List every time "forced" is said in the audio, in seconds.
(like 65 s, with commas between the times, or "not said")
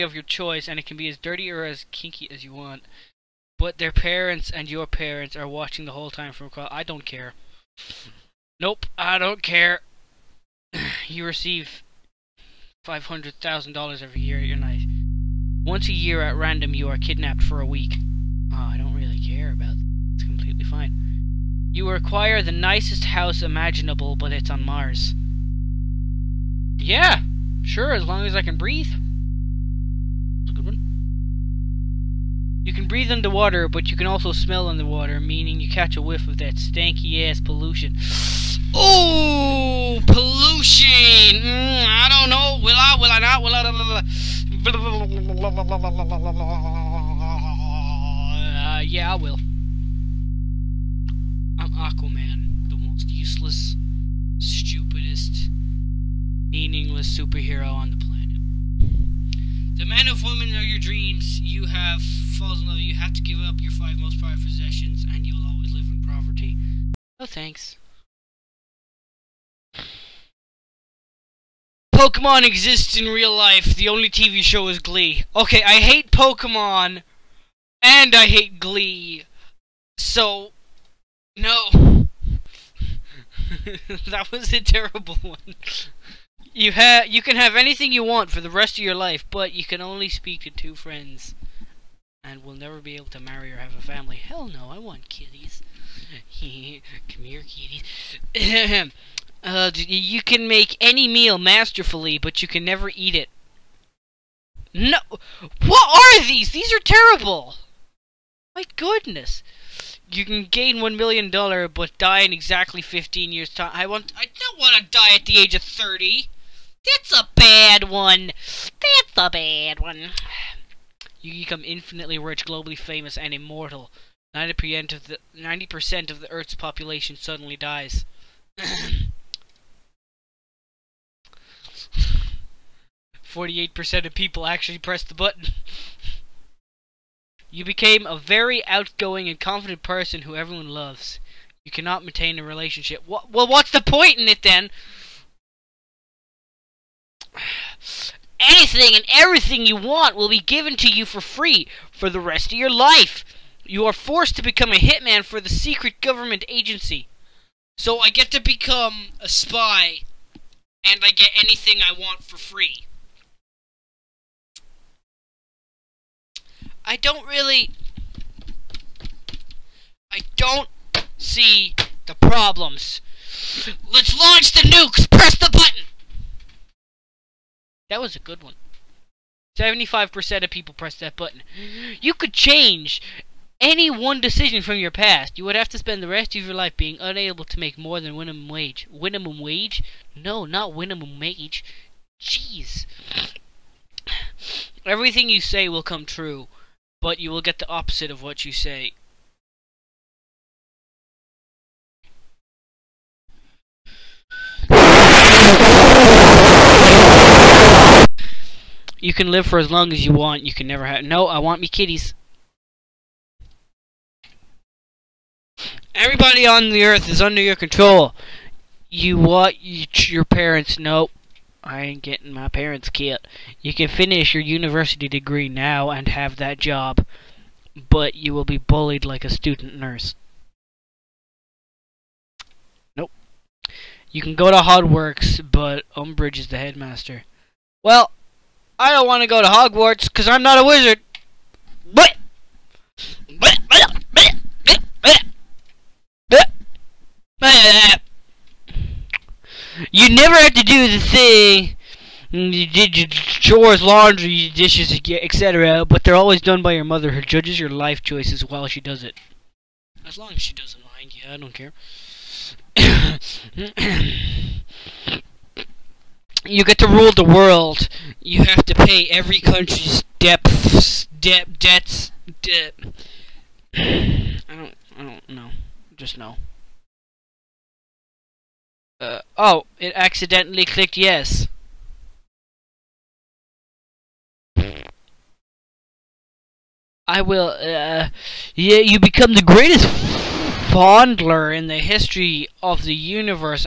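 153 s.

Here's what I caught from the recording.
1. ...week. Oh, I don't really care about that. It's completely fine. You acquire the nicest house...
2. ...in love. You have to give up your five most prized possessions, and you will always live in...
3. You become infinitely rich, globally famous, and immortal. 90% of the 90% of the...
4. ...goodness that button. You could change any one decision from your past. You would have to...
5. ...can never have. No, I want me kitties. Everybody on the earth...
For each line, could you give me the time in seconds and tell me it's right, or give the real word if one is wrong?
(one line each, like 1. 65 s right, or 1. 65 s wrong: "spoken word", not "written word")
1. 17 s right
2. 62 s right
3. 121 s right
4. 180 s wrong: "press", not "goodness"
5. 210 s right.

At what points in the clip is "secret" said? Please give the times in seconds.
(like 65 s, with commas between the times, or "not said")
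155 s.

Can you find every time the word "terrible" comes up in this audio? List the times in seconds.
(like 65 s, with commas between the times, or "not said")
84 s, 106 s.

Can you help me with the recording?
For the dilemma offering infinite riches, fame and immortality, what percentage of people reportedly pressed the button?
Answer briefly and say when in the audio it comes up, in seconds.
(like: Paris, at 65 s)
48%, at 133 s.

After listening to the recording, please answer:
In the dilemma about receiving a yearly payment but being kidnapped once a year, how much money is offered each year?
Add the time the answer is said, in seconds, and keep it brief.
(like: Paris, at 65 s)
$500,000, at 12 s.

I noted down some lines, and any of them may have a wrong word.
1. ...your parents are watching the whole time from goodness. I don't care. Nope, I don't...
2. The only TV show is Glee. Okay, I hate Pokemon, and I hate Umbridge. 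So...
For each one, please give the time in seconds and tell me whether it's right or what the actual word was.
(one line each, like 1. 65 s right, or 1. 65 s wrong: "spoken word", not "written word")
1. 4 s wrong: "across", not "goodness"
2. 73 s wrong: "Glee", not "Umbridge".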